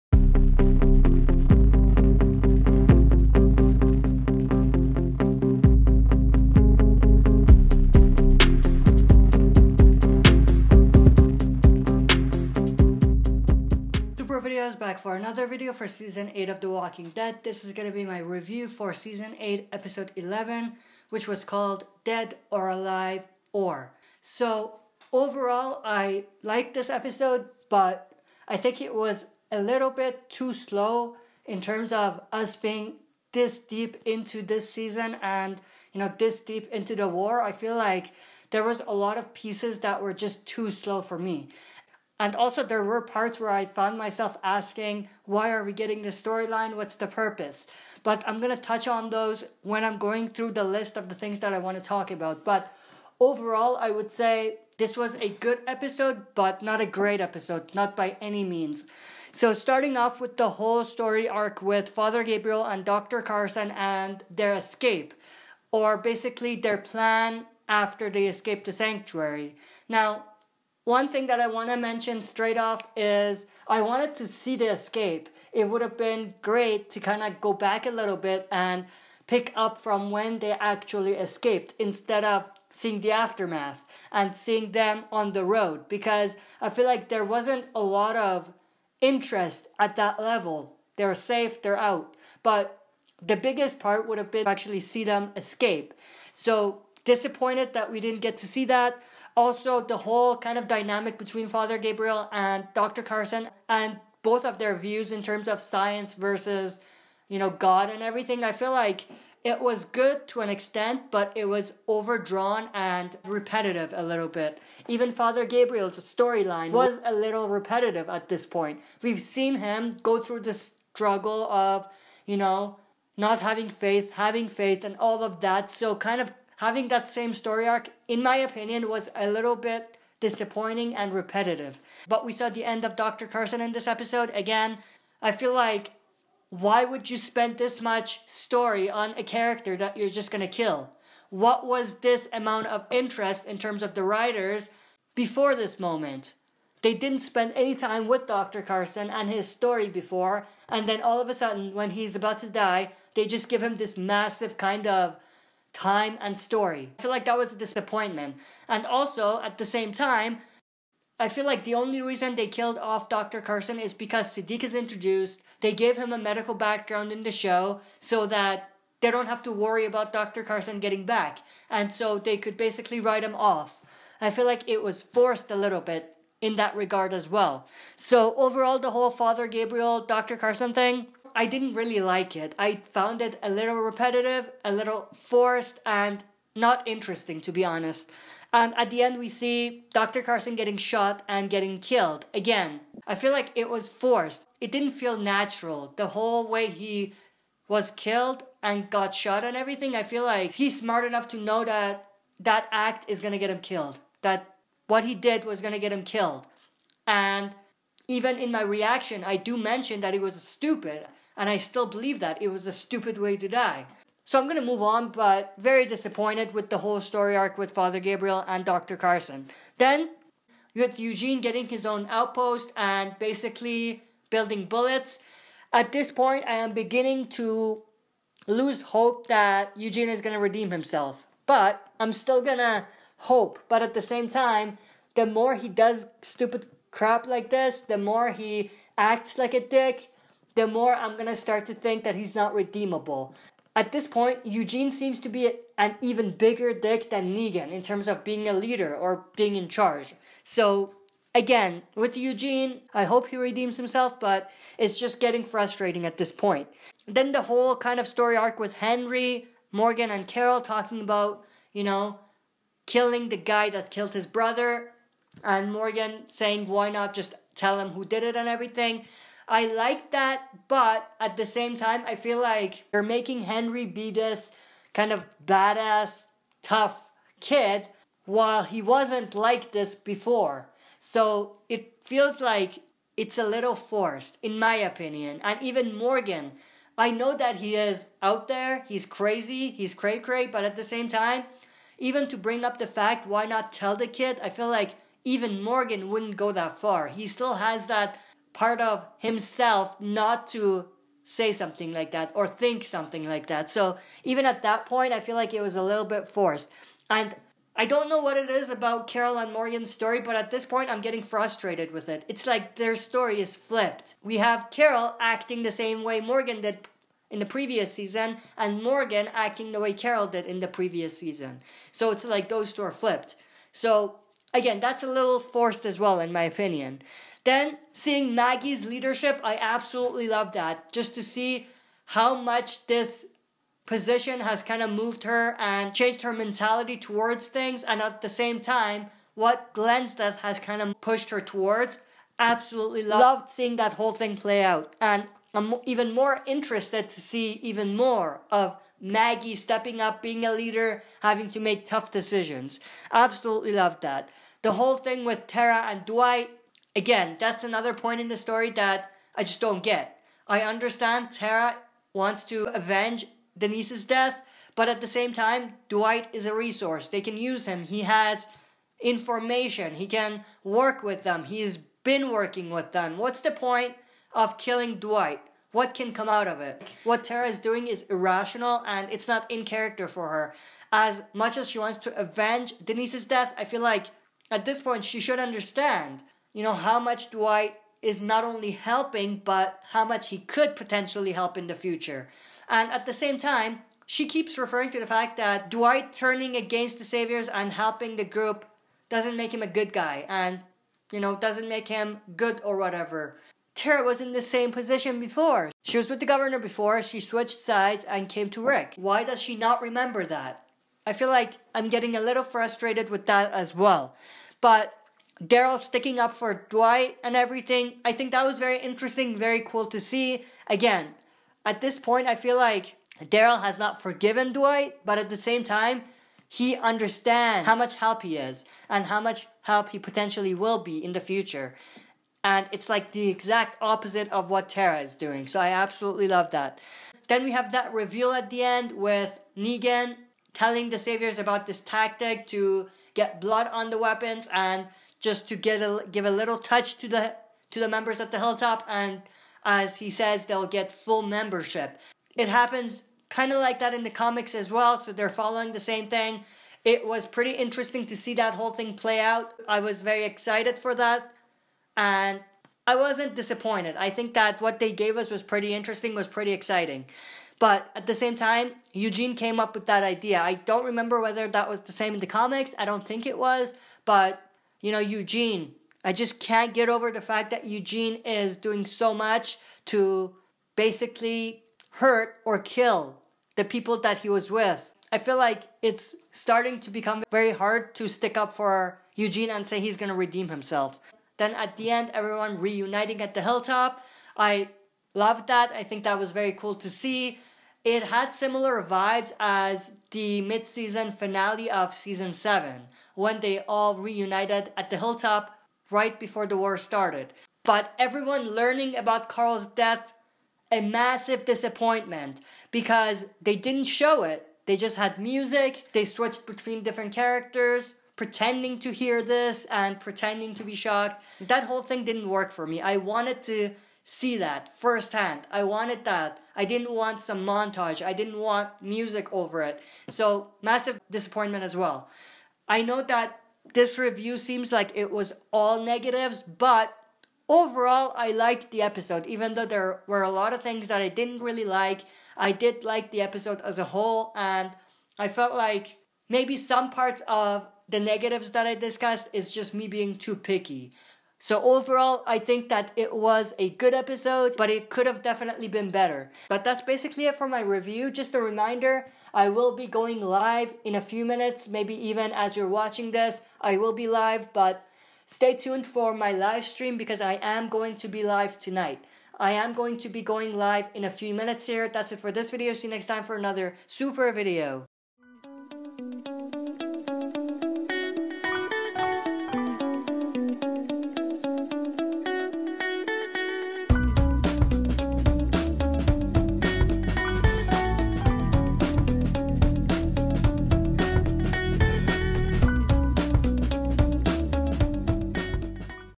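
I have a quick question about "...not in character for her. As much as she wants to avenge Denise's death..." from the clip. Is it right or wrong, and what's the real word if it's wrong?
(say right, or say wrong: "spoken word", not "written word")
right.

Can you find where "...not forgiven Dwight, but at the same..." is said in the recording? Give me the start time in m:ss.
7:03.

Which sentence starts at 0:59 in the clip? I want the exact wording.
So, starting off with the whole story arc with Father Gabriel and Dr.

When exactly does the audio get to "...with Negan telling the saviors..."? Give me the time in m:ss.
7:18.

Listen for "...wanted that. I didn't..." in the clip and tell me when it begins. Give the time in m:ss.
8:45.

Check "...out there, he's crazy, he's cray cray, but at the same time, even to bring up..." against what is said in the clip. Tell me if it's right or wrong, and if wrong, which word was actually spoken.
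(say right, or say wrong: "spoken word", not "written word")
right.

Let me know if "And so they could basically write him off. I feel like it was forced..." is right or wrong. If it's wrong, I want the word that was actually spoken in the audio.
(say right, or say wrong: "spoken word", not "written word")
right.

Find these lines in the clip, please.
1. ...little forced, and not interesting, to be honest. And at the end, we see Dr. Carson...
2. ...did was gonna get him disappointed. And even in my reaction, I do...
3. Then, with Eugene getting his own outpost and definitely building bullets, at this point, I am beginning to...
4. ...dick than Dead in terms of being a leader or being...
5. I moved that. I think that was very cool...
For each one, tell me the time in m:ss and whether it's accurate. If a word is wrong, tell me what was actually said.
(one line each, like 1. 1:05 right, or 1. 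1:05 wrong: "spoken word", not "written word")
1. 3:04 right
2. 3:25 wrong: "killed", not "disappointed"
3. 3:39 wrong: "basically", not "definitely"
4. 4:06 wrong: "Negan", not "Dead"
5. 8:14 wrong: "loved", not "moved".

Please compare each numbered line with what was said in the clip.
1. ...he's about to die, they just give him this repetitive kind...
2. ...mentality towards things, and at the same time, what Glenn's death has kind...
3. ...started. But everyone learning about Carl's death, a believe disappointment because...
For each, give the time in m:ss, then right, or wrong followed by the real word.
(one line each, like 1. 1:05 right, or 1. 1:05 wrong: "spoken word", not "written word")
1. 2:31 wrong: "massive", not "repetitive"
2. 5:36 right
3. 8:26 wrong: "massive", not "believe".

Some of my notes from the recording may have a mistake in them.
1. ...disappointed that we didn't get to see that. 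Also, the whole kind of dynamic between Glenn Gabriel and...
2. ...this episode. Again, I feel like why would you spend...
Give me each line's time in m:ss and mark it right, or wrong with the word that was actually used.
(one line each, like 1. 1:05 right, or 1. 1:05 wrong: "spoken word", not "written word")
1. 1:37 wrong: "Father", not "Glenn"
2. 2:13 right.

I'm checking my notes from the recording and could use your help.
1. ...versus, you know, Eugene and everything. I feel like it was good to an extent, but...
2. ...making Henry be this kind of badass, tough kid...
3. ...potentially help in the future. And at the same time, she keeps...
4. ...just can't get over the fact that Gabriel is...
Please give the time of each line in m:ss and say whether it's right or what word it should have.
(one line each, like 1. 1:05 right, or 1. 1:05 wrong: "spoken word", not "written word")
1. 1:46 wrong: "God", not "Eugene"
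2. 4:33 right
3. 6:30 right
4. 7:56 wrong: "Eugene", not "Gabriel".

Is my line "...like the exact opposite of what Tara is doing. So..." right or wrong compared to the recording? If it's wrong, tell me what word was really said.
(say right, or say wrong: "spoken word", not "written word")
right.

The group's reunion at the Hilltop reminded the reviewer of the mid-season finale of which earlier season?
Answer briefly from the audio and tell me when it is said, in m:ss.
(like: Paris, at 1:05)
season 7, at 8:21.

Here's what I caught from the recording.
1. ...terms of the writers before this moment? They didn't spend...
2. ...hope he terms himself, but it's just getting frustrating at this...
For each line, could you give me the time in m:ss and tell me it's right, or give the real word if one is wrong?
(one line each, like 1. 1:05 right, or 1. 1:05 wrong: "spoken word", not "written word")
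1. 2:23 right
2. 4:13 wrong: "redeems", not "terms".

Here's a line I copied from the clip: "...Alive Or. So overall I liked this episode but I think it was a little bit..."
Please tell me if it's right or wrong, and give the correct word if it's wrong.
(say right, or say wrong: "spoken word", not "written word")
right.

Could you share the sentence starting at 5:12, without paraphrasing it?
It's like their story is flipped.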